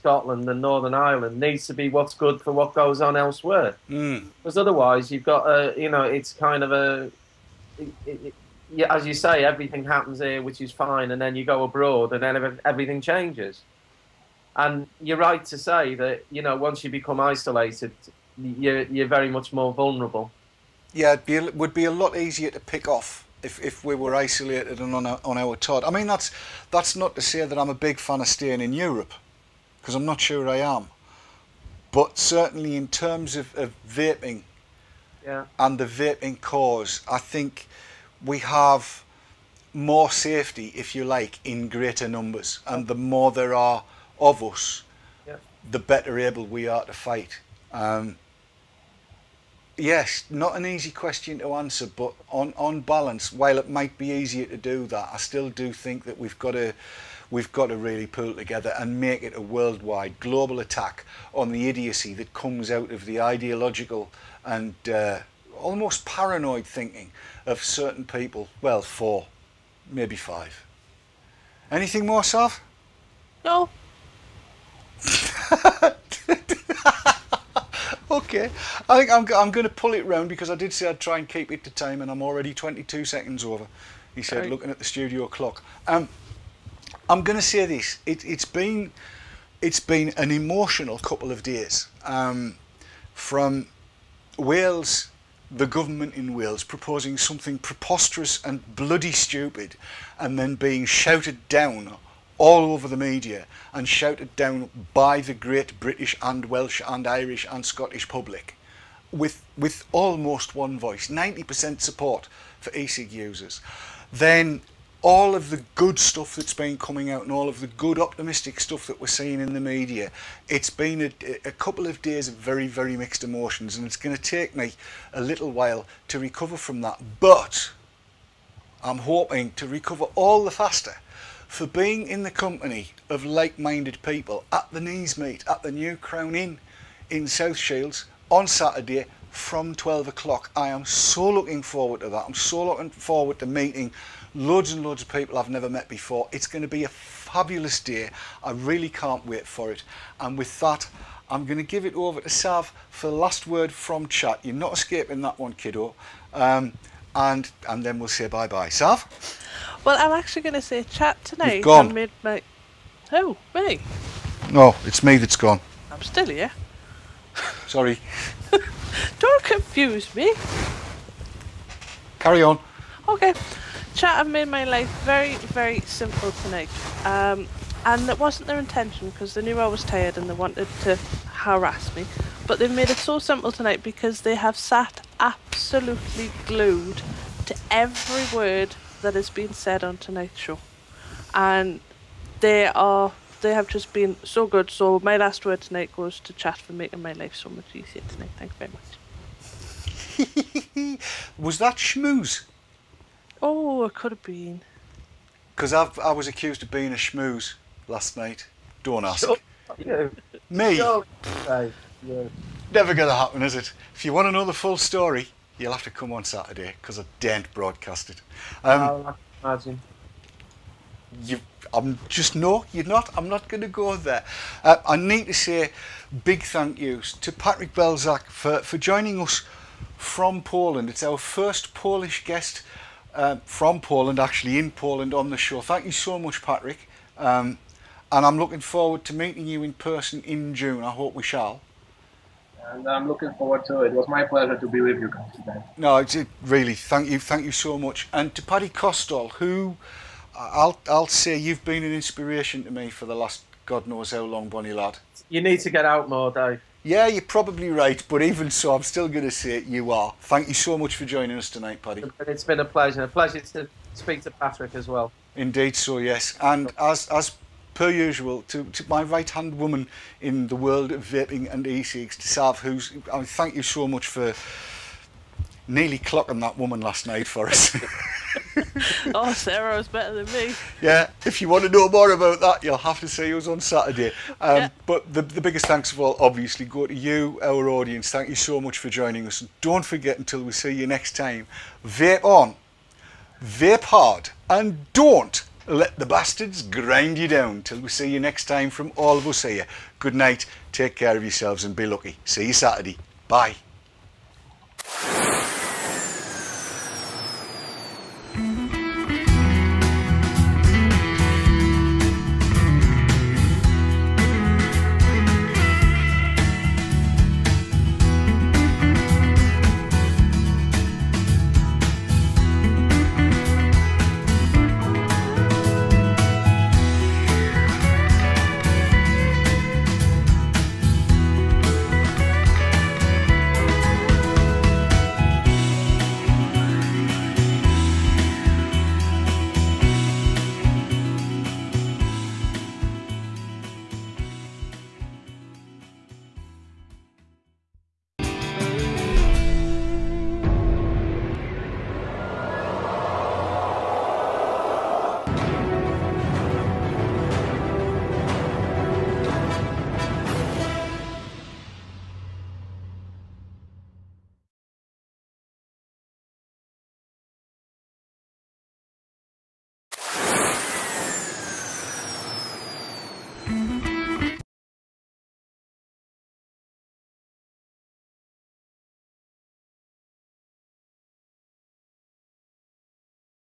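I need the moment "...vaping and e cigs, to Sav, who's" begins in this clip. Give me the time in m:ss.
4:31.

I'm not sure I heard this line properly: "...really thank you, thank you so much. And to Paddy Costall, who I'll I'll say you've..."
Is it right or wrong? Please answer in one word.
right.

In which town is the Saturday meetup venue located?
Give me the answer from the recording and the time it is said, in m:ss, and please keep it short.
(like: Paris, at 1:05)
South Shields, at 2:17.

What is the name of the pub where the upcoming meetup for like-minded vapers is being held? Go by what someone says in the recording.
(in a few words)
New Crown Inn.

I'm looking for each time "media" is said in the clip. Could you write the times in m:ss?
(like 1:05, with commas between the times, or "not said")
1:42, 1:59.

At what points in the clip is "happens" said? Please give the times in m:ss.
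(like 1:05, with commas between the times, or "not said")
0:09, 3:33.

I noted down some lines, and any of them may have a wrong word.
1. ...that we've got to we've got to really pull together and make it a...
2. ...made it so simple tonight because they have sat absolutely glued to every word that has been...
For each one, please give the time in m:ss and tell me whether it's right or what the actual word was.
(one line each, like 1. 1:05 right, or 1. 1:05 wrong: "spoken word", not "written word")
1. 0:56 right
2. 3:02 right.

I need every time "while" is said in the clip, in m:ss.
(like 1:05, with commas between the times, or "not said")
0:53, 2:05.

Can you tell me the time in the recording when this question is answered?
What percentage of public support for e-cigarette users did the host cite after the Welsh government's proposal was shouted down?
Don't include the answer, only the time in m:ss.
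1:51.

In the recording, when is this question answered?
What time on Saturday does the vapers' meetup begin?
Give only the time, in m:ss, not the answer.
2:19.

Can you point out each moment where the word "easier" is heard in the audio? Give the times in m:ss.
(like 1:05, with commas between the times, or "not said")
0:22, 0:54, 3:17.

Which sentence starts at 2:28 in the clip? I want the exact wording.
I really can't wait for it.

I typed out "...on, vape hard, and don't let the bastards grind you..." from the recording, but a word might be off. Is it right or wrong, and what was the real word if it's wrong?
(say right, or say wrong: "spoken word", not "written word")
right.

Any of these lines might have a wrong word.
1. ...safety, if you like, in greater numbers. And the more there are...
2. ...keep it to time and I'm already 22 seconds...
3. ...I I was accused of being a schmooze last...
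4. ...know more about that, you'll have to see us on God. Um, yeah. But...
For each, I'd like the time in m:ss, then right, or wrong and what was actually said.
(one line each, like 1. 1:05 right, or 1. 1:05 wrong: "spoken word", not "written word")
1. 0:40 right
2. 1:21 right
3. 3:25 right
4. 4:41 wrong: "Saturday", not "God".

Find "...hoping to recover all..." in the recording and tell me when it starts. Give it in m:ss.
2:08.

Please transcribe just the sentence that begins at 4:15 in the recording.
You need to get out more, Dave.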